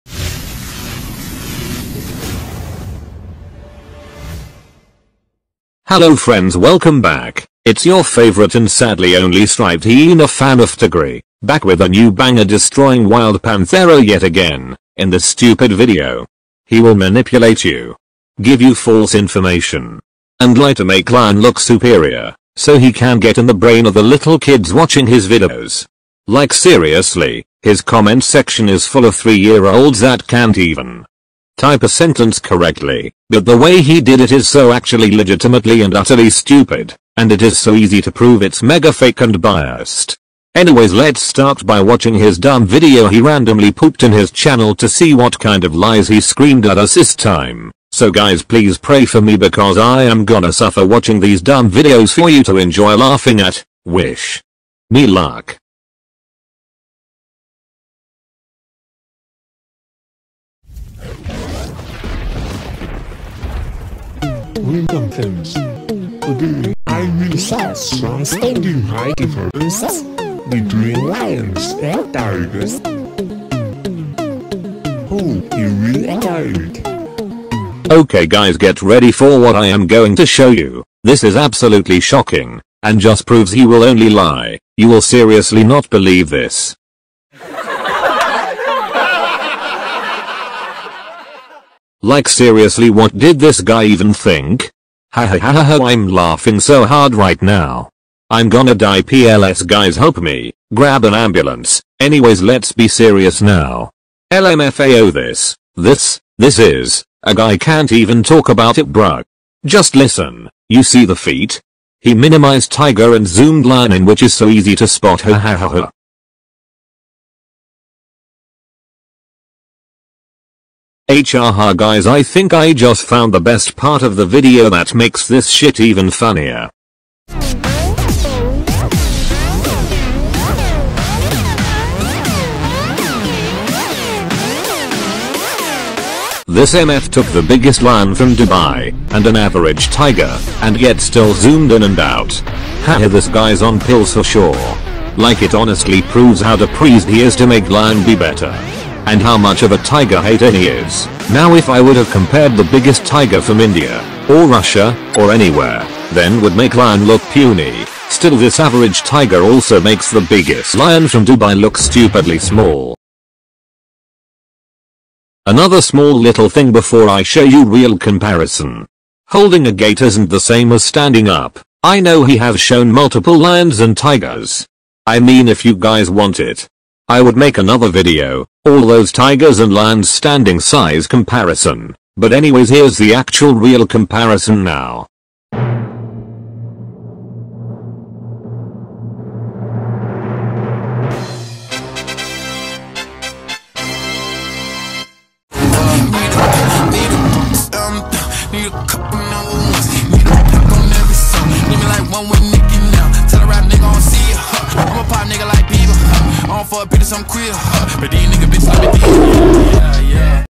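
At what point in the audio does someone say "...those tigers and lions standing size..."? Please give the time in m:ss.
2:58.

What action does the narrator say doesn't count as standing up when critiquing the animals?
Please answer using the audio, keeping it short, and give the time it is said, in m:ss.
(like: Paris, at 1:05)
Holding a gate, at 2:49.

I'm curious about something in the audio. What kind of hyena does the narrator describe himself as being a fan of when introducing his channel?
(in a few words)
Striped hyena.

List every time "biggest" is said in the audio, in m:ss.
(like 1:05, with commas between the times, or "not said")
2:17, 2:32, 2:40.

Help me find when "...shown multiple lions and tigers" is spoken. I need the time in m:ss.
2:52.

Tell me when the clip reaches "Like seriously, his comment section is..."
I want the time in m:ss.
0:26.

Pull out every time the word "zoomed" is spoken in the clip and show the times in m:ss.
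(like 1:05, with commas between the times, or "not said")
1:53, 2:21.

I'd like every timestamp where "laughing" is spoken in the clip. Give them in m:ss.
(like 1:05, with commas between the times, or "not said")
0:52, 1:36.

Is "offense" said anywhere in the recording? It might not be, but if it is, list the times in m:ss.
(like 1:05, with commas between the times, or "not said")
not said.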